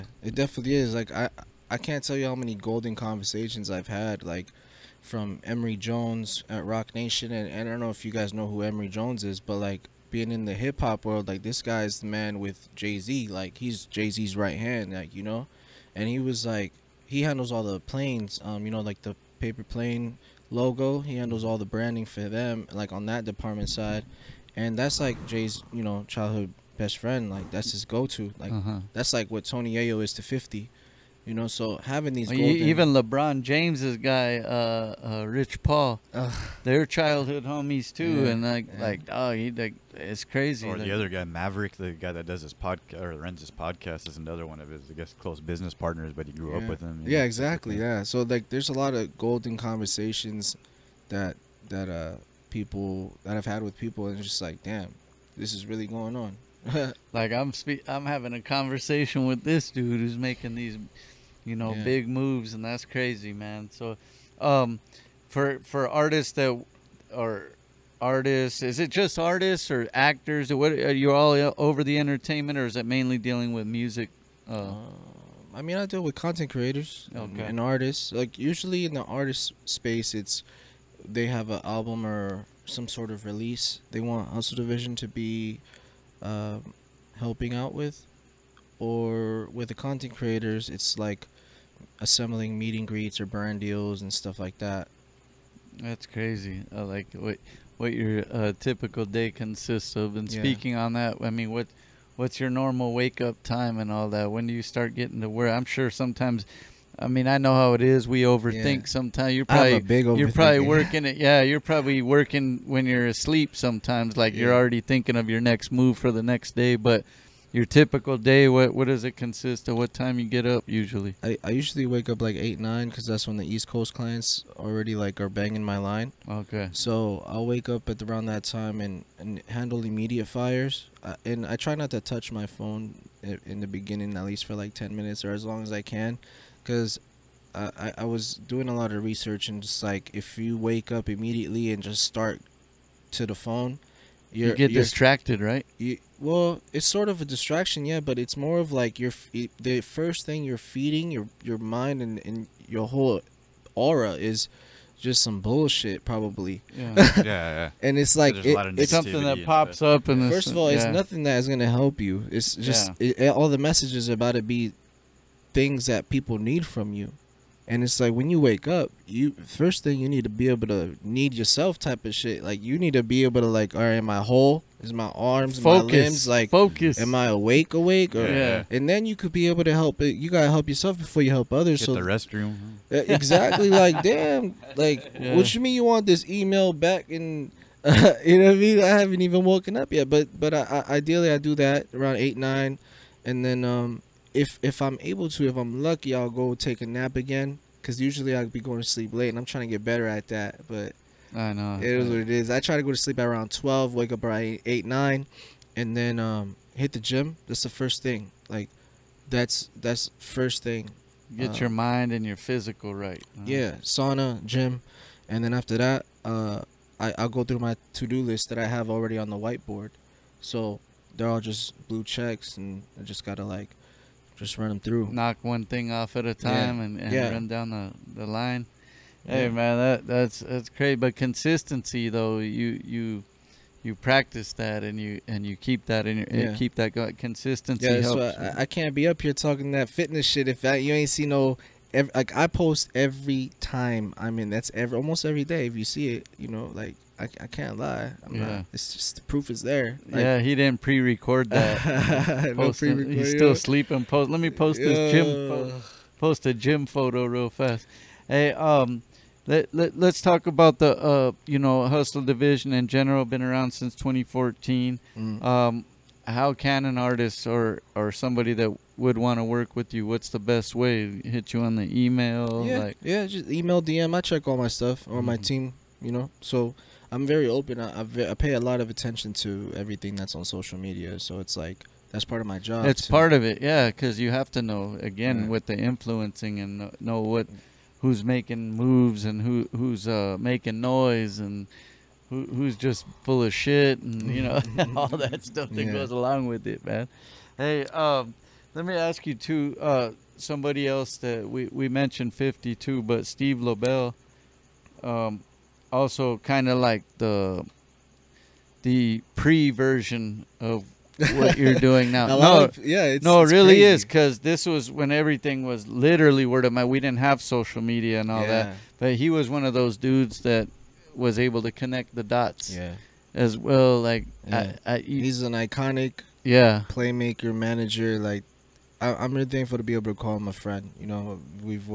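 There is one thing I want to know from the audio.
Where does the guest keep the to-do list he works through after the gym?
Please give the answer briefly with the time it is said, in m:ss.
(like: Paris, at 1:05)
whiteboard, at 3:39.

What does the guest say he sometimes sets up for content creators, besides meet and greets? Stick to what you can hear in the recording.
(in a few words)
burn deals.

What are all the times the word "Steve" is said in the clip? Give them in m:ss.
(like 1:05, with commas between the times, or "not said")
5:03.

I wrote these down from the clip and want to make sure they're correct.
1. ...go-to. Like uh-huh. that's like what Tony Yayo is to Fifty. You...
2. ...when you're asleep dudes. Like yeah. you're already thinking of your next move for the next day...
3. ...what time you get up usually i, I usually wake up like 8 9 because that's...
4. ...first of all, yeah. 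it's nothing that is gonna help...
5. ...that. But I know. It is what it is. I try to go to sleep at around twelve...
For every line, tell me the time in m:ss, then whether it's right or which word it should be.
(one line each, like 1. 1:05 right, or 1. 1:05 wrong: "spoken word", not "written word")
1. 0:27 right
2. 1:52 wrong: "sometimes", not "dudes"
3. 1:59 right
4. 2:40 right
5. 3:20 right.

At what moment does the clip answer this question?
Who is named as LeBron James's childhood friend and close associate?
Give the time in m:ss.
0:35.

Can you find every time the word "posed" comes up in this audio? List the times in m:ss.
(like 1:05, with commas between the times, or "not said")
not said.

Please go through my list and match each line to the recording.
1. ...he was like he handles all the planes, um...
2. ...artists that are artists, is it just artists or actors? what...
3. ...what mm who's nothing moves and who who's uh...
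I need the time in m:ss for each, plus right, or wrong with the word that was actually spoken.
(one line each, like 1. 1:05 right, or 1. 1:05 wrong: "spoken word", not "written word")
1. 0:16 right
2. 1:05 right
3. 4:47 wrong: "making", not "nothing".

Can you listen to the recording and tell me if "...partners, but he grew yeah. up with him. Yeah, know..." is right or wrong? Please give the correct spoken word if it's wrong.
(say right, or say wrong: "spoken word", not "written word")
right.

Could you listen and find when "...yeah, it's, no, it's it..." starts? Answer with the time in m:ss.
5:12.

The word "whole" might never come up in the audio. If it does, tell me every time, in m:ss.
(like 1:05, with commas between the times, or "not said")
2:32, 2:54.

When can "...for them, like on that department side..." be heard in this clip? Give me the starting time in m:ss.
0:22.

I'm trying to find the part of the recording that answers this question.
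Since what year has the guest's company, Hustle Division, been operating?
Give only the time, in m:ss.
4:23.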